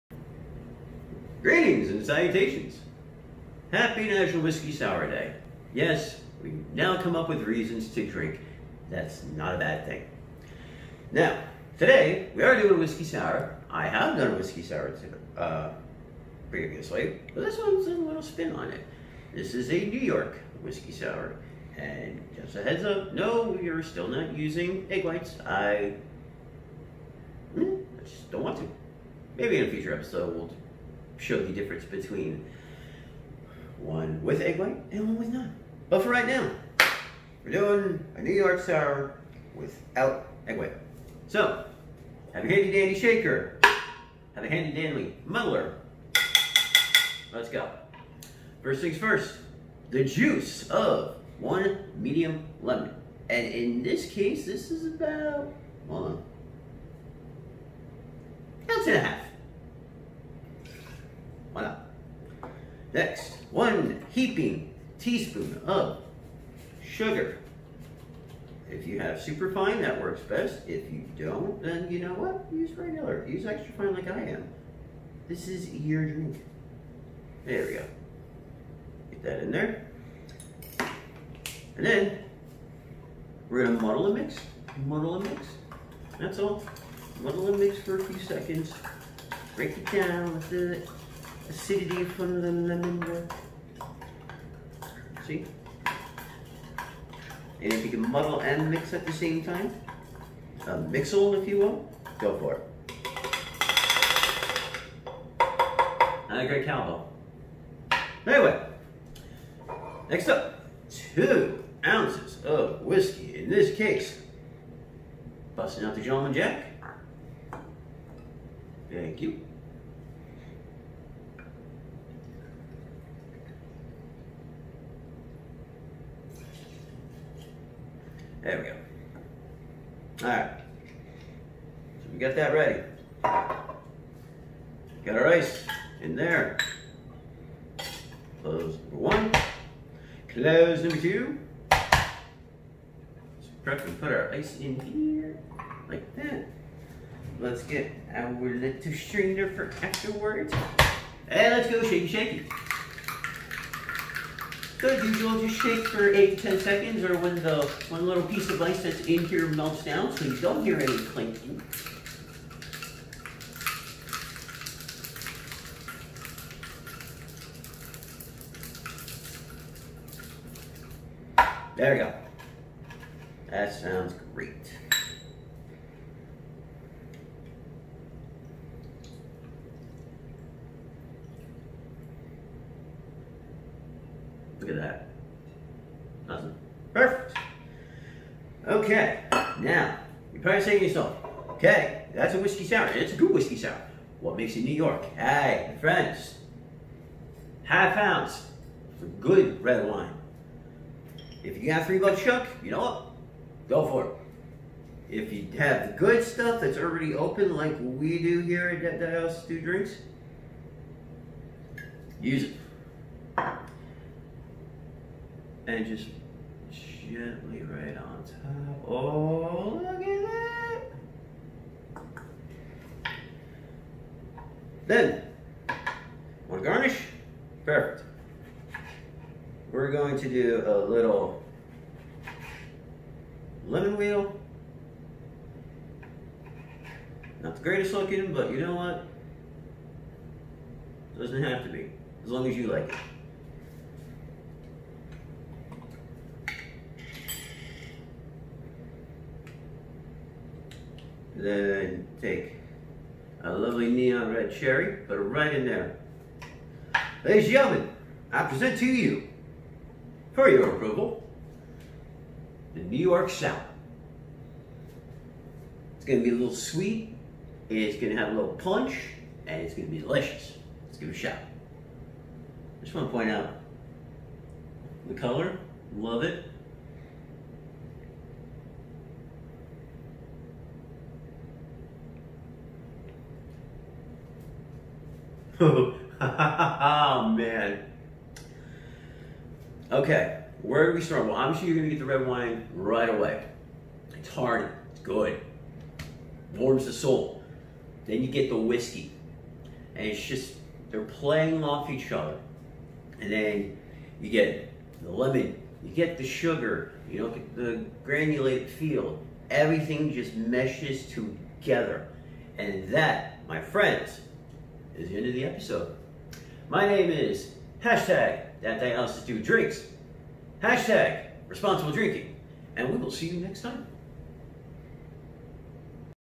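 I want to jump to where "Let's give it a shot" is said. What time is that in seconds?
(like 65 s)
270 s.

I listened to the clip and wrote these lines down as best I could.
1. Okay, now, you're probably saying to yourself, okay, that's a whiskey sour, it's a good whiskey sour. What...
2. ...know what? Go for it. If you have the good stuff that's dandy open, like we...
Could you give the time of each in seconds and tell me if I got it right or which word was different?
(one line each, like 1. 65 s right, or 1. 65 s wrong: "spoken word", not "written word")
1. 188 s right
2. 202 s wrong: "already", not "dandy".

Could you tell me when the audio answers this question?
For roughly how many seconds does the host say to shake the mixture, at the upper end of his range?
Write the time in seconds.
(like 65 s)
156 s.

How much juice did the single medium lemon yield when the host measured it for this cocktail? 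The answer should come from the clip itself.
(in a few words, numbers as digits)
1.5 ounces.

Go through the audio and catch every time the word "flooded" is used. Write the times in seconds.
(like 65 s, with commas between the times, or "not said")
not said.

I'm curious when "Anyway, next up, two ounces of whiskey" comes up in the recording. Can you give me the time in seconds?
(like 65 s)
108 s.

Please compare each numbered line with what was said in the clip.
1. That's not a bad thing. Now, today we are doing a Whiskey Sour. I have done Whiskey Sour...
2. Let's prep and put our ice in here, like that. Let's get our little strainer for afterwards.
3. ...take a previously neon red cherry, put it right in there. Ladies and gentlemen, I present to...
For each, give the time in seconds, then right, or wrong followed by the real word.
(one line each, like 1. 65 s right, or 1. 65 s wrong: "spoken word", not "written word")
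1. 8 s right
2. 141 s right
3. 252 s wrong: "lovely", not "previously".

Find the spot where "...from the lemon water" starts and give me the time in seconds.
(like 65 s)
92 s.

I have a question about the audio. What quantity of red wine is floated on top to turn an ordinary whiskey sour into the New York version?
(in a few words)
Half ounce.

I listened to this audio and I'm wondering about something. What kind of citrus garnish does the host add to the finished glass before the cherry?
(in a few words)
Lemon wheel.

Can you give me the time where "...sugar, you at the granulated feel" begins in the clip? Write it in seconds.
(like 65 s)
306 s.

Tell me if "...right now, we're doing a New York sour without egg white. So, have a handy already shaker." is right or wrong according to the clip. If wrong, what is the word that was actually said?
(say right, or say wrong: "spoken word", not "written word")
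wrong: "dandy", not "already".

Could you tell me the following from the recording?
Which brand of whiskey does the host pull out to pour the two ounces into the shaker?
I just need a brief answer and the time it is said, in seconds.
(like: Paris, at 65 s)
Gentleman Jack, at 116 s.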